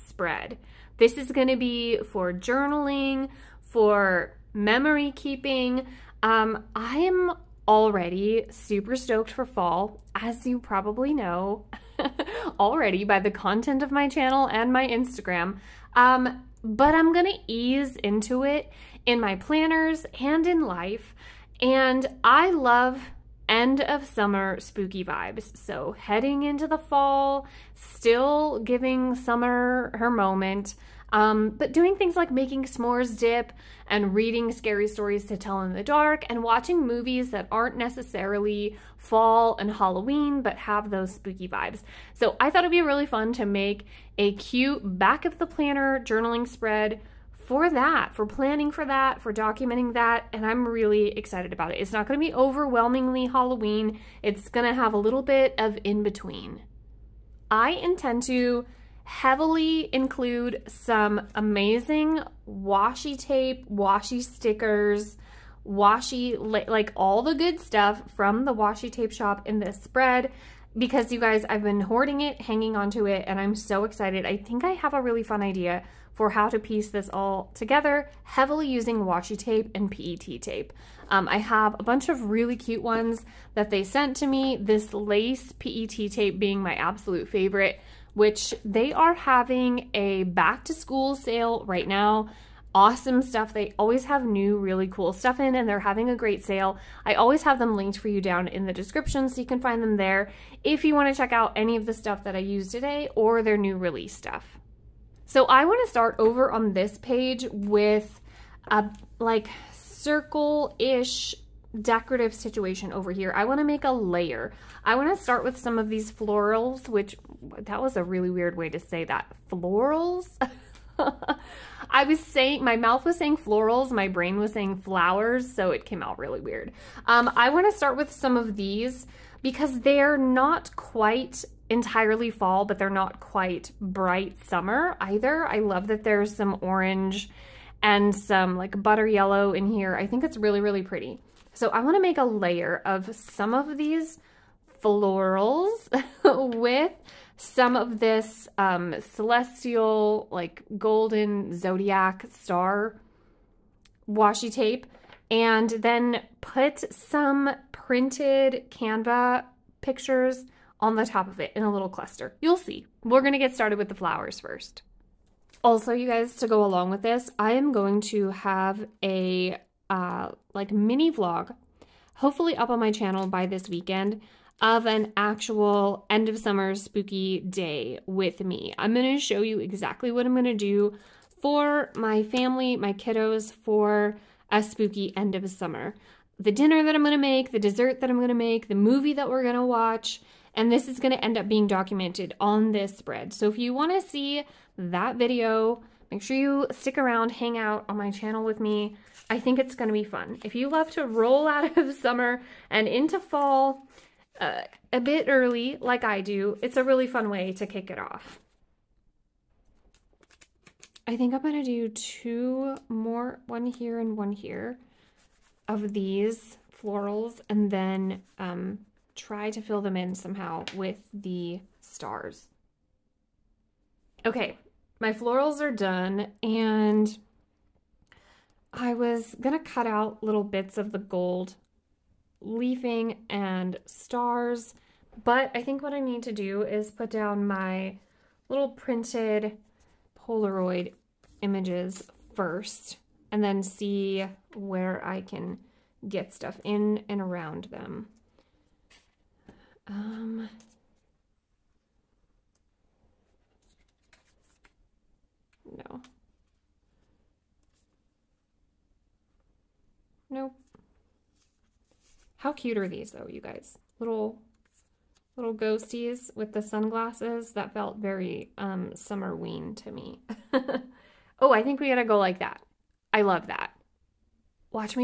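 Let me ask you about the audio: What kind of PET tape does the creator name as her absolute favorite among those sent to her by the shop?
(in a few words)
Lace.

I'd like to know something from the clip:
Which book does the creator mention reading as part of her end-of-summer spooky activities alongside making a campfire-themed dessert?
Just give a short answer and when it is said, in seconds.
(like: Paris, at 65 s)
Scary Stories to Tell in the Dark, at 34 s.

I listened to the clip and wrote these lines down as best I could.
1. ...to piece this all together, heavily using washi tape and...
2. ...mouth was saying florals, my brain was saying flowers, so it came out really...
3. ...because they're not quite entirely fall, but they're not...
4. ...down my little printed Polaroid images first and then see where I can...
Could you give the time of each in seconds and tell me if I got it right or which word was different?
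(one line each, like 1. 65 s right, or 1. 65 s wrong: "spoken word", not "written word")
1. 76 s right
2. 122 s right
3. 129 s right
4. 237 s right.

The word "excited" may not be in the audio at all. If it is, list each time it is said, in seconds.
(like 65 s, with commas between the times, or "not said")
51 s, 73 s.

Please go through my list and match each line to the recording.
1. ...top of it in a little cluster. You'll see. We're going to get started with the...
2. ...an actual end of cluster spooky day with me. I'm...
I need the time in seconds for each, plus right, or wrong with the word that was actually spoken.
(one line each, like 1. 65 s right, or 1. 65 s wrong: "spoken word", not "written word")
1. 161 s right
2. 174 s wrong: "summer", not "cluster".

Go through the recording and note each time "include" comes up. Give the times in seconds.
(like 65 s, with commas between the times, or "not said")
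59 s.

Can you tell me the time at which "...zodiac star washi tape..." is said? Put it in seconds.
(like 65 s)
151 s.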